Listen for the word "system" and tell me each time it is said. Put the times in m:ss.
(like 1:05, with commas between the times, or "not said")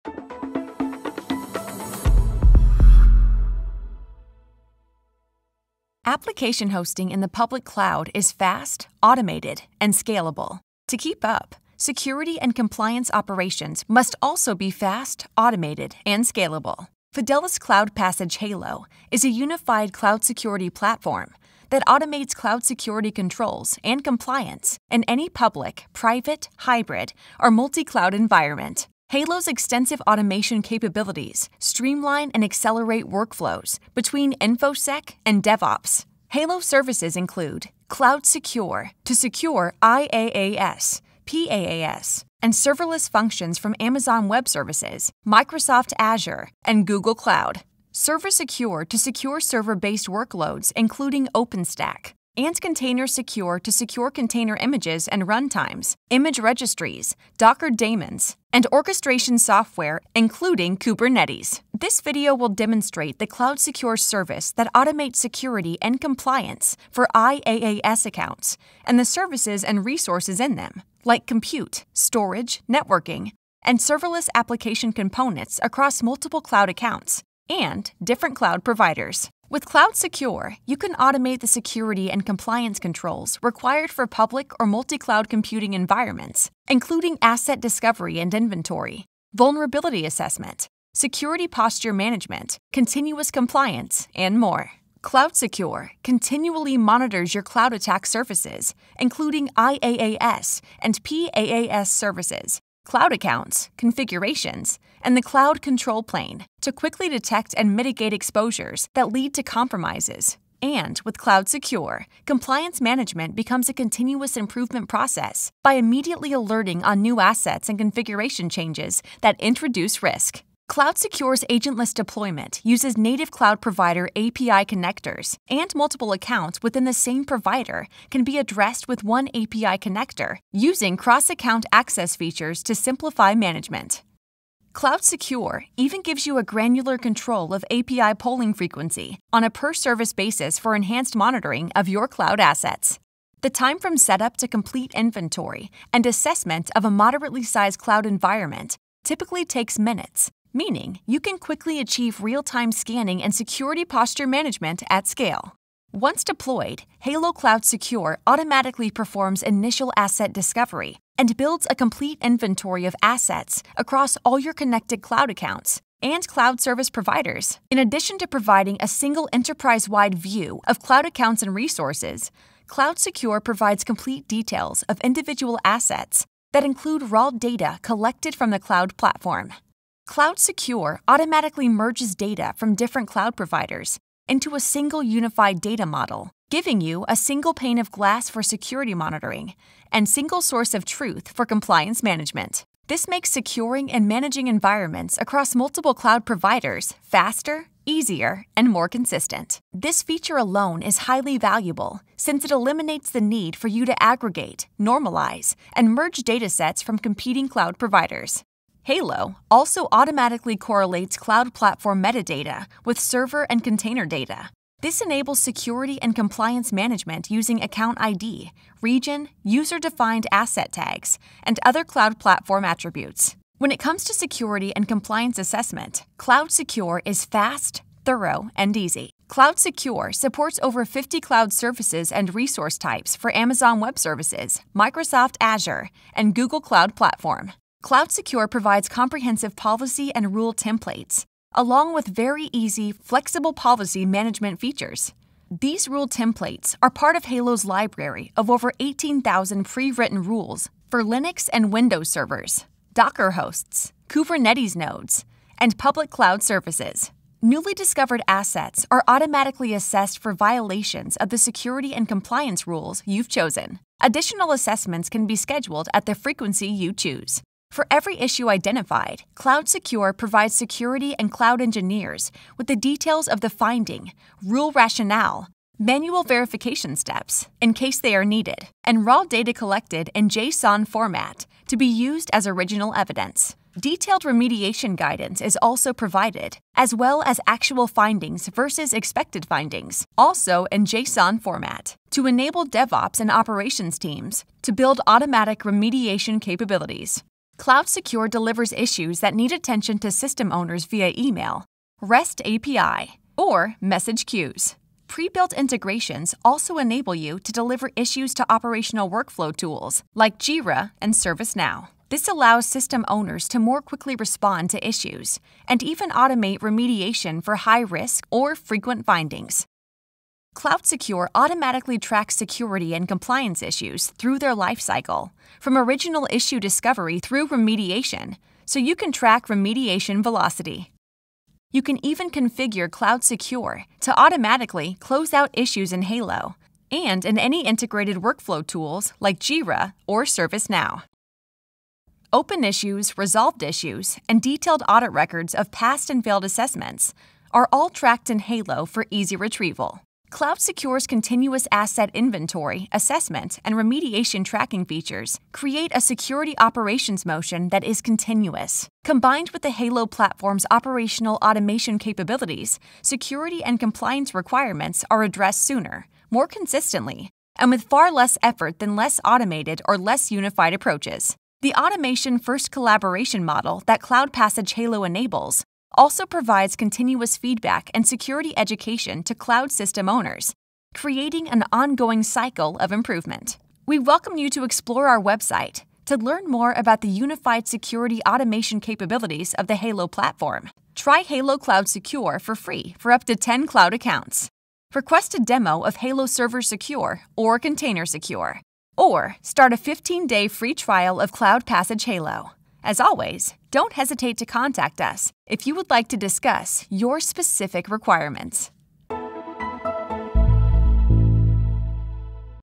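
5:00, 5:12, 6:19.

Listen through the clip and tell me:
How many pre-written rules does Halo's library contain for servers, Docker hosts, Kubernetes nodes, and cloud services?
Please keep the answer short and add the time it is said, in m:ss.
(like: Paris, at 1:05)
over 18,000, at 4:08.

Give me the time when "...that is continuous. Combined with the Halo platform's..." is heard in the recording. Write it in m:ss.
5:57.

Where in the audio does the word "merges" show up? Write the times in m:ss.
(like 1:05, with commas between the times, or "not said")
3:01, 3:25.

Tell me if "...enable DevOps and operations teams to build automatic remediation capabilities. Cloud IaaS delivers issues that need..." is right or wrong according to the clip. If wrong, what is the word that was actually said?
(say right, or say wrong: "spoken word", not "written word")
wrong: "Secure", not "IaaS".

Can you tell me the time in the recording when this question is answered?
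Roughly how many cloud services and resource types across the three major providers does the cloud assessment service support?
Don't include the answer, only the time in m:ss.
3:50.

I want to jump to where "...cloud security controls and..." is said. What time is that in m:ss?
0:22.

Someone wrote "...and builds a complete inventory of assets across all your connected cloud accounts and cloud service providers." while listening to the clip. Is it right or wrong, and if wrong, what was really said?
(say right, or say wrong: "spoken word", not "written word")
right.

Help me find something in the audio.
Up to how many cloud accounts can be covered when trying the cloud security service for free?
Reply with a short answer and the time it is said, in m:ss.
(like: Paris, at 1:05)
10, at 6:33.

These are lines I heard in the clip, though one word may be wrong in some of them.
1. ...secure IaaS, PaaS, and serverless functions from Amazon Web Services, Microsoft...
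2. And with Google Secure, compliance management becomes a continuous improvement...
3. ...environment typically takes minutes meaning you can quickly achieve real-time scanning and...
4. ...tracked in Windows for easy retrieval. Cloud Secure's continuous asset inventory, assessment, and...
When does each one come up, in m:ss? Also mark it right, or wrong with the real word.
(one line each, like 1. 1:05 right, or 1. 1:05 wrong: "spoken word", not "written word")
1. 0:39 right
2. 1:50 wrong: "Cloud", not "Google"
3. 2:28 right
4. 5:47 wrong: "Halo", not "Windows".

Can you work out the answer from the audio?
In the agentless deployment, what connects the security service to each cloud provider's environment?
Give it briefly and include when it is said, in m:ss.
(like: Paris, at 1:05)
API connectors, at 2:04.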